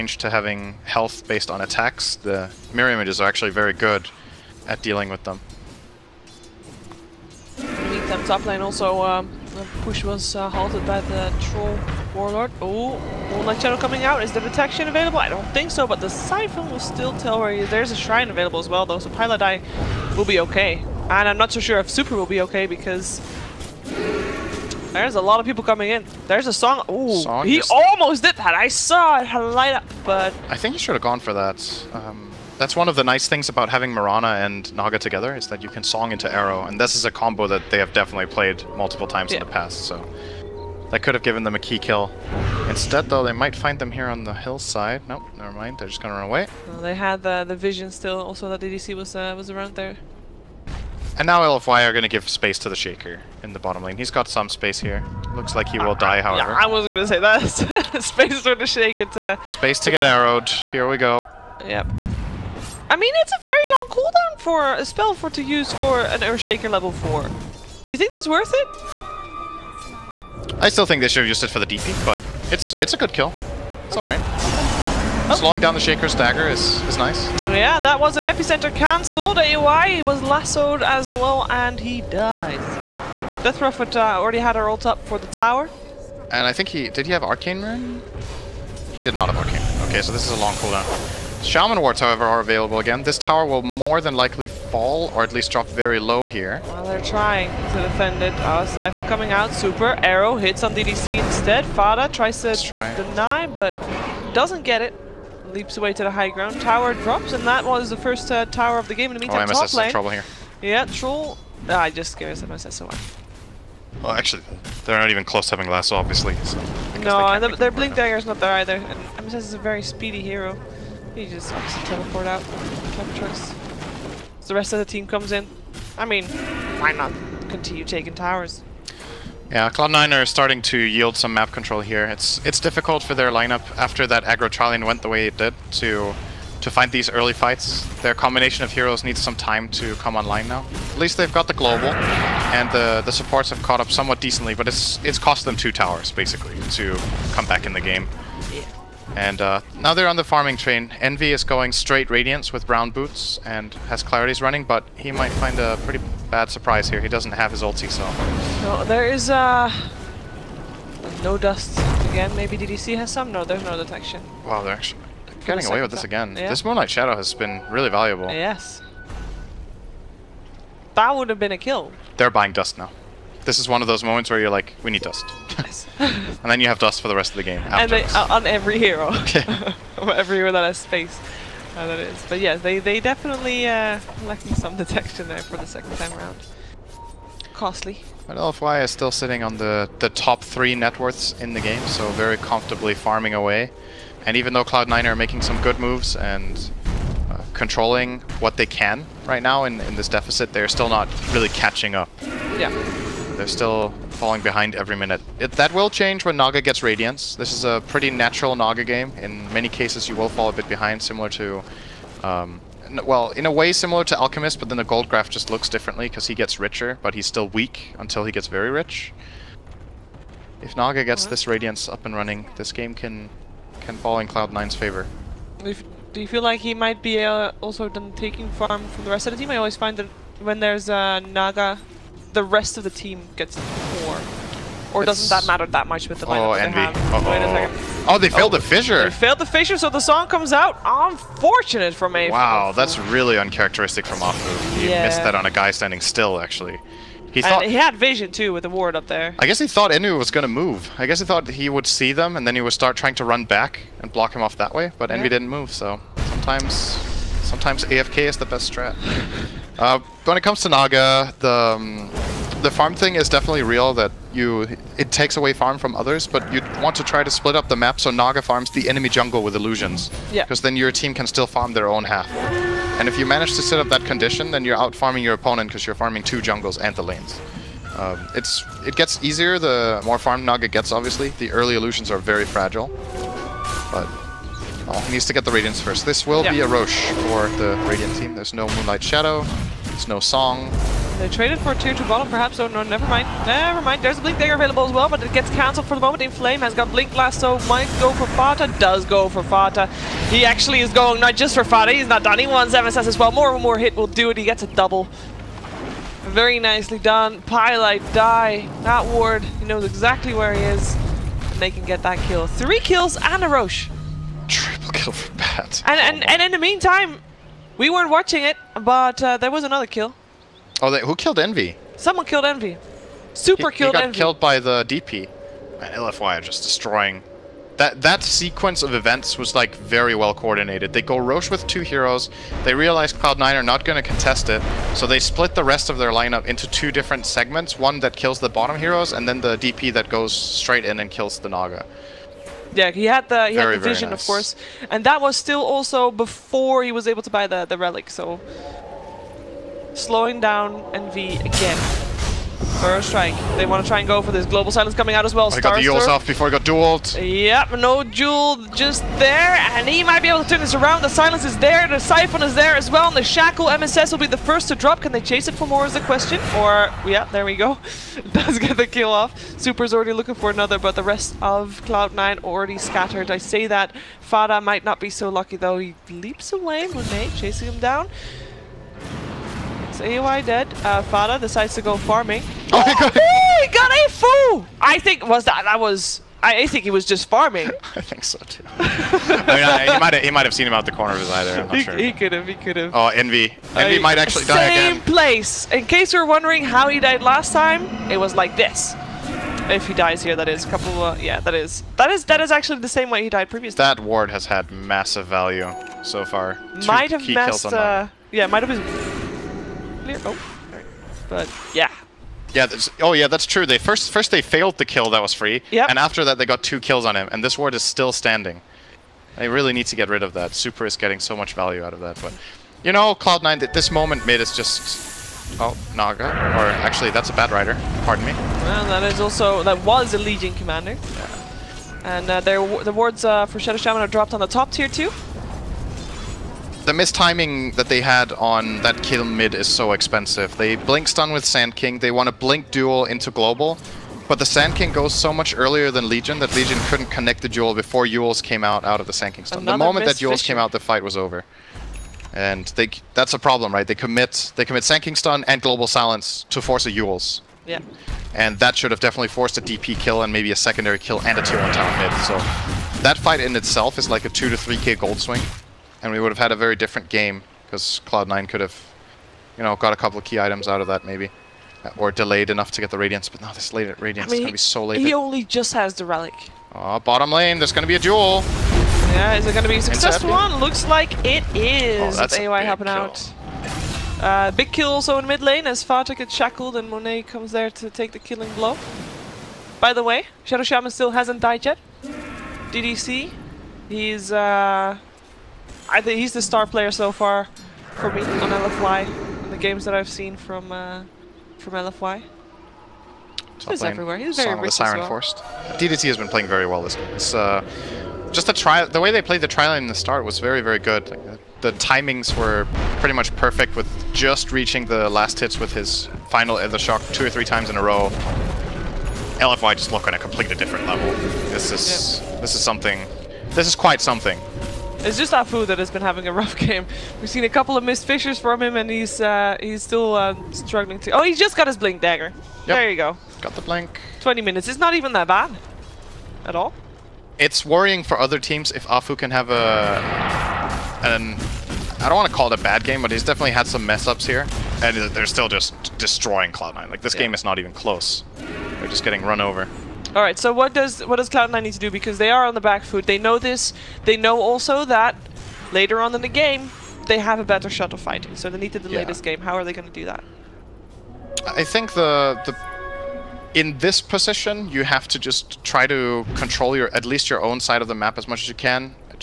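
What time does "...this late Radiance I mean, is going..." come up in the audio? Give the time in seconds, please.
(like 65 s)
473 s.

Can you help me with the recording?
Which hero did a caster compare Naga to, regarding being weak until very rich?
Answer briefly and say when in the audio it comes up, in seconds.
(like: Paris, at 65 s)
Alchemist, at 214 s.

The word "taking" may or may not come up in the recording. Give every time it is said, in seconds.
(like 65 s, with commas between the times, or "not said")
127 s, 228 s.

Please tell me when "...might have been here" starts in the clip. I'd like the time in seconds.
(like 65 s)
408 s.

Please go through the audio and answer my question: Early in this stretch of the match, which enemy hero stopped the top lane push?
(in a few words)
Troll Warlord.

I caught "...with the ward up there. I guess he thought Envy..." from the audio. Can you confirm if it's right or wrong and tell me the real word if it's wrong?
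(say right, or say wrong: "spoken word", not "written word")
right.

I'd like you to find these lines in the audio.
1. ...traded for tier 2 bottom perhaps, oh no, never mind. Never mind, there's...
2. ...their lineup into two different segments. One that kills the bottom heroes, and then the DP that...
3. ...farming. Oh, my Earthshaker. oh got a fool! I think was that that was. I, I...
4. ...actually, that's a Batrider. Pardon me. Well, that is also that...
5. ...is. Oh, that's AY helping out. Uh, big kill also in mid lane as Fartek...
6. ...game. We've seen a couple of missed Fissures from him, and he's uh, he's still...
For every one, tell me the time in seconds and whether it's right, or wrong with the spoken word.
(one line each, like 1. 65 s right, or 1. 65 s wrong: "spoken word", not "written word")
1. 291 s right
2. 335 s right
3. 381 s wrong: "God", not "Earthshaker"
4. 426 s right
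5. 481 s right
6. 526 s right.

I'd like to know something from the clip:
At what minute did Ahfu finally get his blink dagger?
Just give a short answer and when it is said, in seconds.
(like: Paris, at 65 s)
20, at 534 s.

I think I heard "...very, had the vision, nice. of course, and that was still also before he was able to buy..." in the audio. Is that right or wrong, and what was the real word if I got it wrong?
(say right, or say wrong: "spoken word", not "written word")
right.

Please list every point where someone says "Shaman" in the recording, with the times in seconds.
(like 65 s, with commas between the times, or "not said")
91 s, 433 s, 490 s.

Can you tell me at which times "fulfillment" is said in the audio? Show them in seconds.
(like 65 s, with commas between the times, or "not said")
not said.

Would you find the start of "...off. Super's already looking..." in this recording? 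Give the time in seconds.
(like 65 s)
369 s.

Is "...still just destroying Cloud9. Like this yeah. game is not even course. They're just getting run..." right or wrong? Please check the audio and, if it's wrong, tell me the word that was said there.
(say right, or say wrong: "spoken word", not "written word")
wrong: "close", not "course".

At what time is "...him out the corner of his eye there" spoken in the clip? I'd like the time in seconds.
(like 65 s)
390 s.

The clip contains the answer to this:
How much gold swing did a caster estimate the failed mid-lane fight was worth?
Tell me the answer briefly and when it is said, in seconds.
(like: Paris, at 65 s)
2 to 3k, at 464 s.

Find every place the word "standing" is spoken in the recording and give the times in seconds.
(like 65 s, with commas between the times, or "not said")
245 s, 418 s.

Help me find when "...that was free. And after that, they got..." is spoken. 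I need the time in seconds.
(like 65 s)
415 s.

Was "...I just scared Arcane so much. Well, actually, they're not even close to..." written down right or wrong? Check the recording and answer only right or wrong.
wrong.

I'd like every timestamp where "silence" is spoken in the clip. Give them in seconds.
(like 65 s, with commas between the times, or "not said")
354 s, 361 s, 455 s.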